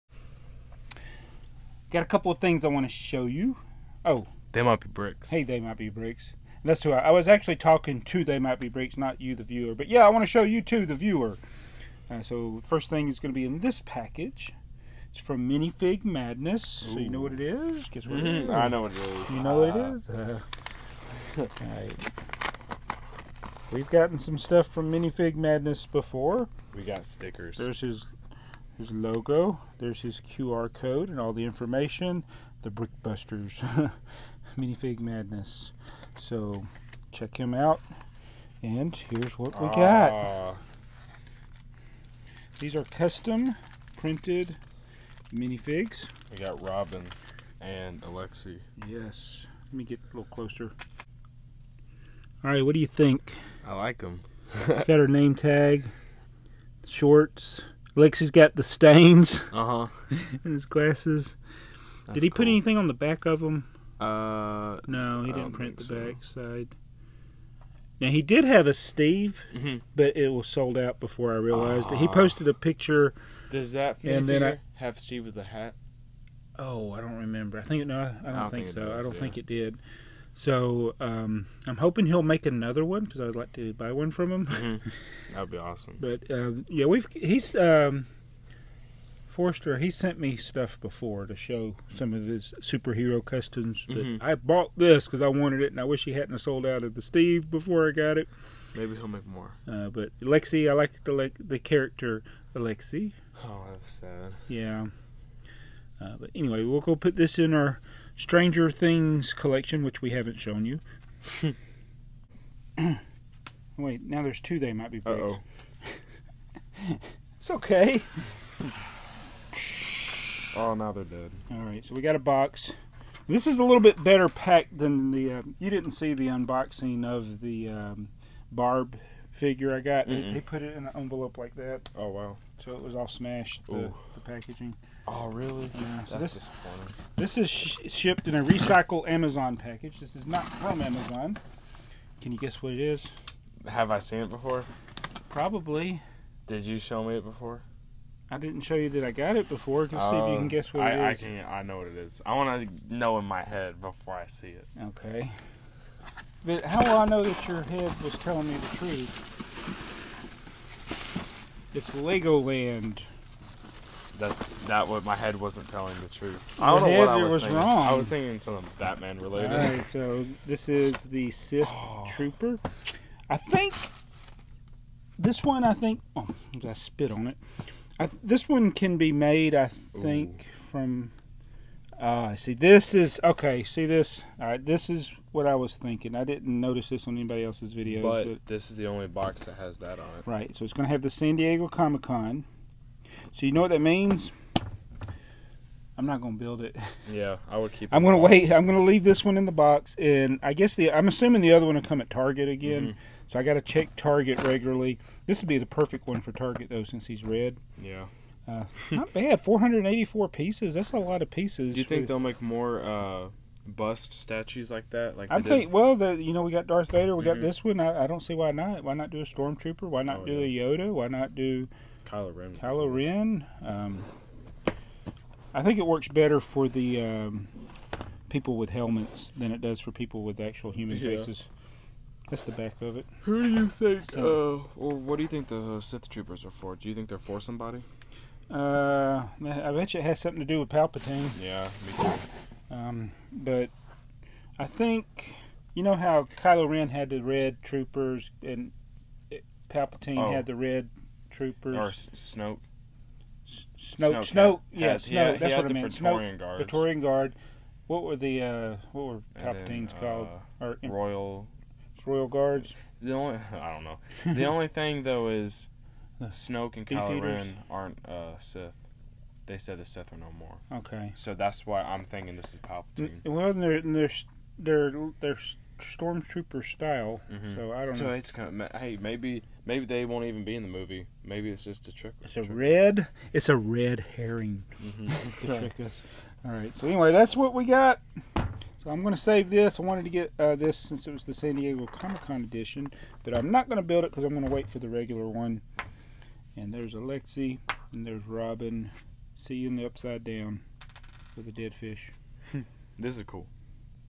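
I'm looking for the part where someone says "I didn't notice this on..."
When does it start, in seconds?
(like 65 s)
186 s.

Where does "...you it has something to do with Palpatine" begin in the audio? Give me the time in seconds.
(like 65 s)
239 s.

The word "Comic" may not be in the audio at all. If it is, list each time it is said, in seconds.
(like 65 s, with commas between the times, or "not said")
191 s, 291 s.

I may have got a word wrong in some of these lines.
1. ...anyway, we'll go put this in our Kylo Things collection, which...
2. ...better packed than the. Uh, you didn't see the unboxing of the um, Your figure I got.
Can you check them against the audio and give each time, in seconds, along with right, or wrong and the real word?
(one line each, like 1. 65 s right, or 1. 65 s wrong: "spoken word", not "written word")
1. 106 s wrong: "Stranger", not "Kylo"
2. 124 s wrong: "Barb", not "Your".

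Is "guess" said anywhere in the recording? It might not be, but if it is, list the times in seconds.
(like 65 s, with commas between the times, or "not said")
17 s, 142 s, 150 s, 200 s.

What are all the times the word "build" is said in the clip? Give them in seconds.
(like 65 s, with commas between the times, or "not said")
196 s, 293 s.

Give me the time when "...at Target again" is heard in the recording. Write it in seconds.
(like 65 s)
201 s.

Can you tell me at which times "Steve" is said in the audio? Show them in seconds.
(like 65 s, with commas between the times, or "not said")
68 s, 74 s, 97 s.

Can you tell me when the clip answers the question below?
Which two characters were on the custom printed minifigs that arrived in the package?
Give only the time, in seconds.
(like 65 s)
46 s.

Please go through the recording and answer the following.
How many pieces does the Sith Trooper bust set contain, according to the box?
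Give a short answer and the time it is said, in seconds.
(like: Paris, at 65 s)
484, at 209 s.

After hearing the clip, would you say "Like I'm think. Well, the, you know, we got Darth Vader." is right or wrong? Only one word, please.
right.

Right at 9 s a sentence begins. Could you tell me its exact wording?
But yeah, I want to show you too, the viewer.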